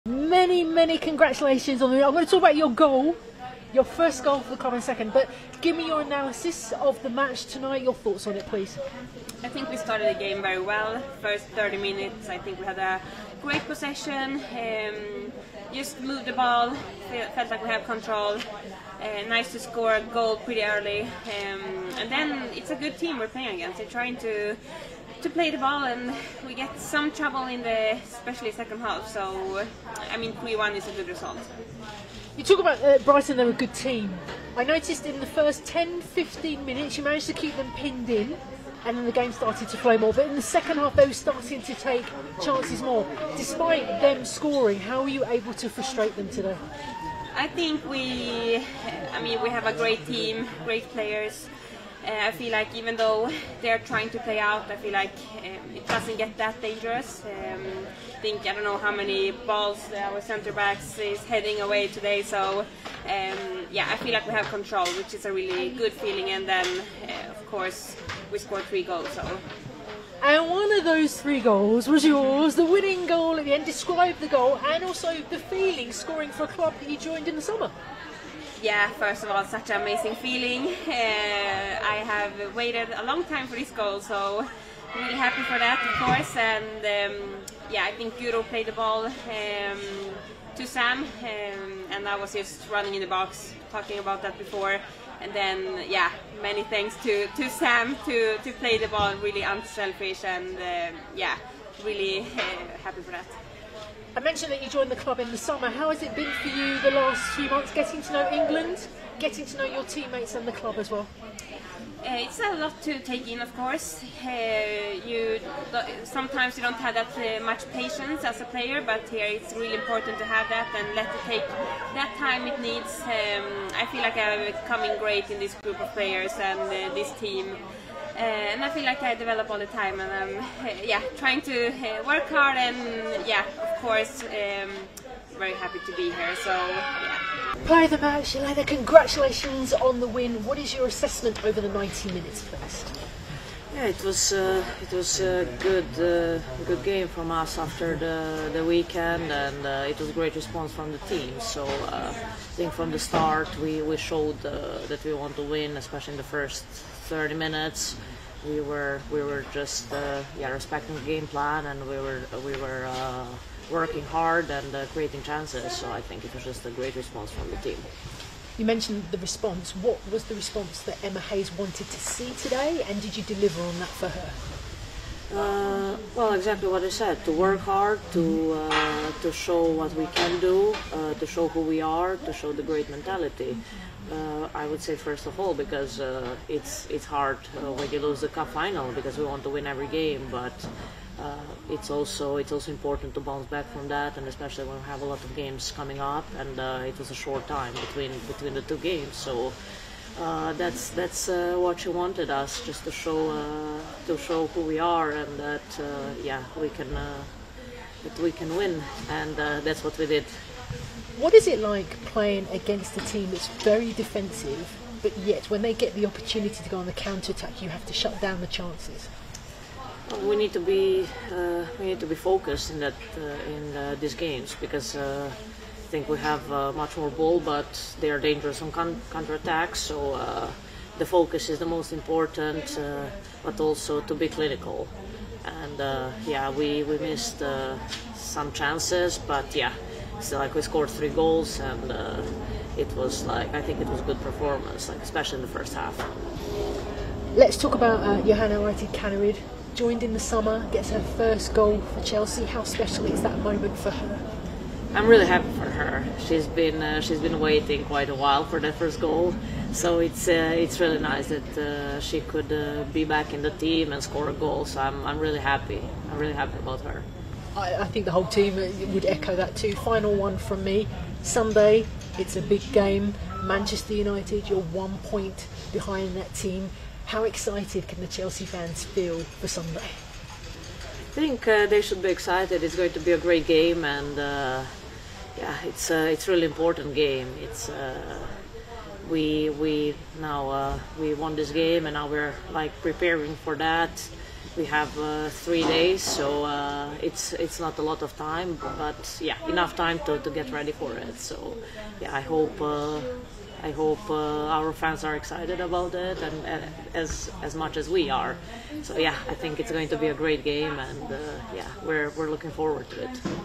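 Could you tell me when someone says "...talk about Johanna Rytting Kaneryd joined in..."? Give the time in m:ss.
4:07.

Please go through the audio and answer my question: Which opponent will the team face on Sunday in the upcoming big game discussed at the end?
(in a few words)
Manchester United.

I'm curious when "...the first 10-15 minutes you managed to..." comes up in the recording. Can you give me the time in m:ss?
0:35.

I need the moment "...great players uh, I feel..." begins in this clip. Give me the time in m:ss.
0:50.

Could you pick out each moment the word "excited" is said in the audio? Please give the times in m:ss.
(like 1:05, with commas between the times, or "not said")
4:37, 4:42, 5:05.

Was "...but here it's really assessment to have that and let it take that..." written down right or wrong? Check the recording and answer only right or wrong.
wrong.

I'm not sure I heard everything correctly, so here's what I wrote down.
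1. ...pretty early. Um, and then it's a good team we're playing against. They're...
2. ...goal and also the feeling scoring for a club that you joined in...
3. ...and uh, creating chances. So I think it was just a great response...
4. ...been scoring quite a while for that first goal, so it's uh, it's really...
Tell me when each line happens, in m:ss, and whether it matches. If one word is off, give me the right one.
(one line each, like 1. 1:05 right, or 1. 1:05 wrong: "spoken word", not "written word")
1. 0:20 right
2. 1:14 right
3. 2:44 right
4. 4:17 wrong: "waiting", not "scoring".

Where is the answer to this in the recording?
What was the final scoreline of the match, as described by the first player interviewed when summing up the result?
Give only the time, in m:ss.
0:30.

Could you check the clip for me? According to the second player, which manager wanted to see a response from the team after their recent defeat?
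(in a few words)
Emma Hayes.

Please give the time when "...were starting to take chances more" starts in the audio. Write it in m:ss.
0:41.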